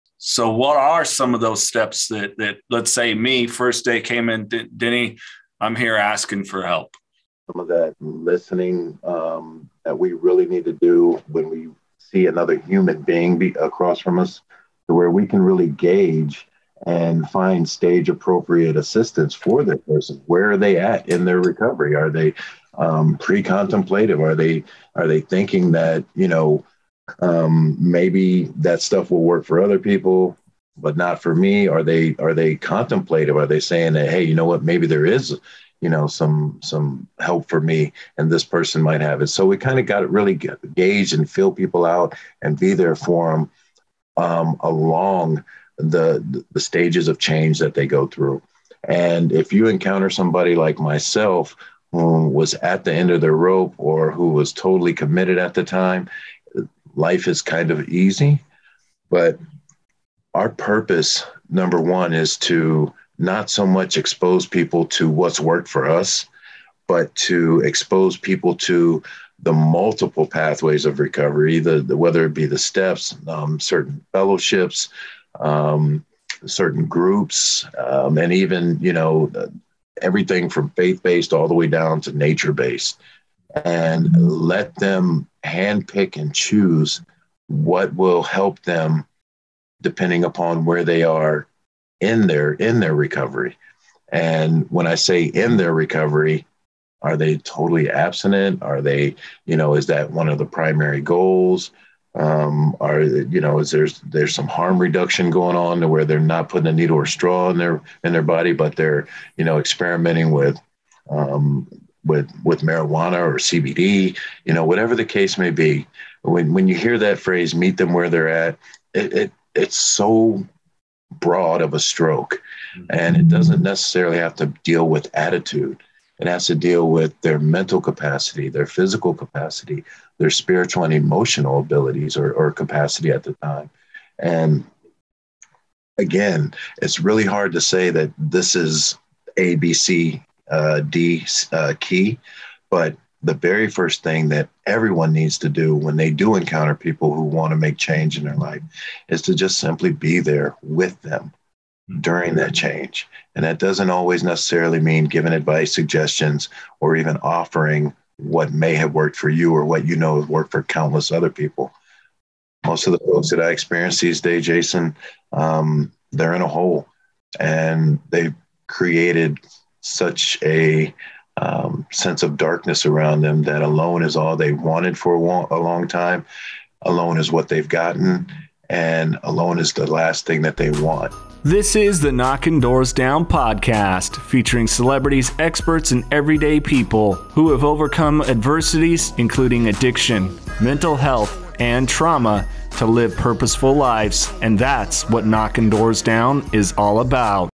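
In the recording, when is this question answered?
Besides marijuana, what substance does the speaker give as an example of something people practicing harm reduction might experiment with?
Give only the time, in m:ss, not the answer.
1:53.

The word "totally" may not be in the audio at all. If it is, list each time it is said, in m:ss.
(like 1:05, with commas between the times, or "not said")
0:54, 1:37.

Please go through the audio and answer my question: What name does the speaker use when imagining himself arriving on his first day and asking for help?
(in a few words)
Denny.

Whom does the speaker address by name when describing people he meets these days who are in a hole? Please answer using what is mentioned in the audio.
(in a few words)
Jason.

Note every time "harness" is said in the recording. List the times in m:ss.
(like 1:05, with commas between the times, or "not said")
not said.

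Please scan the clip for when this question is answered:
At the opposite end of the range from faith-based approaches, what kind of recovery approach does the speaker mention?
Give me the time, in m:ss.
1:22.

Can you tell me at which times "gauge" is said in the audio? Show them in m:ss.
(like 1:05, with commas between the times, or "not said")
0:15, 0:40.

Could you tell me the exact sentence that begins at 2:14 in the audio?
And again, it's really hard to say that this is A, B, C, uh, D uh, key.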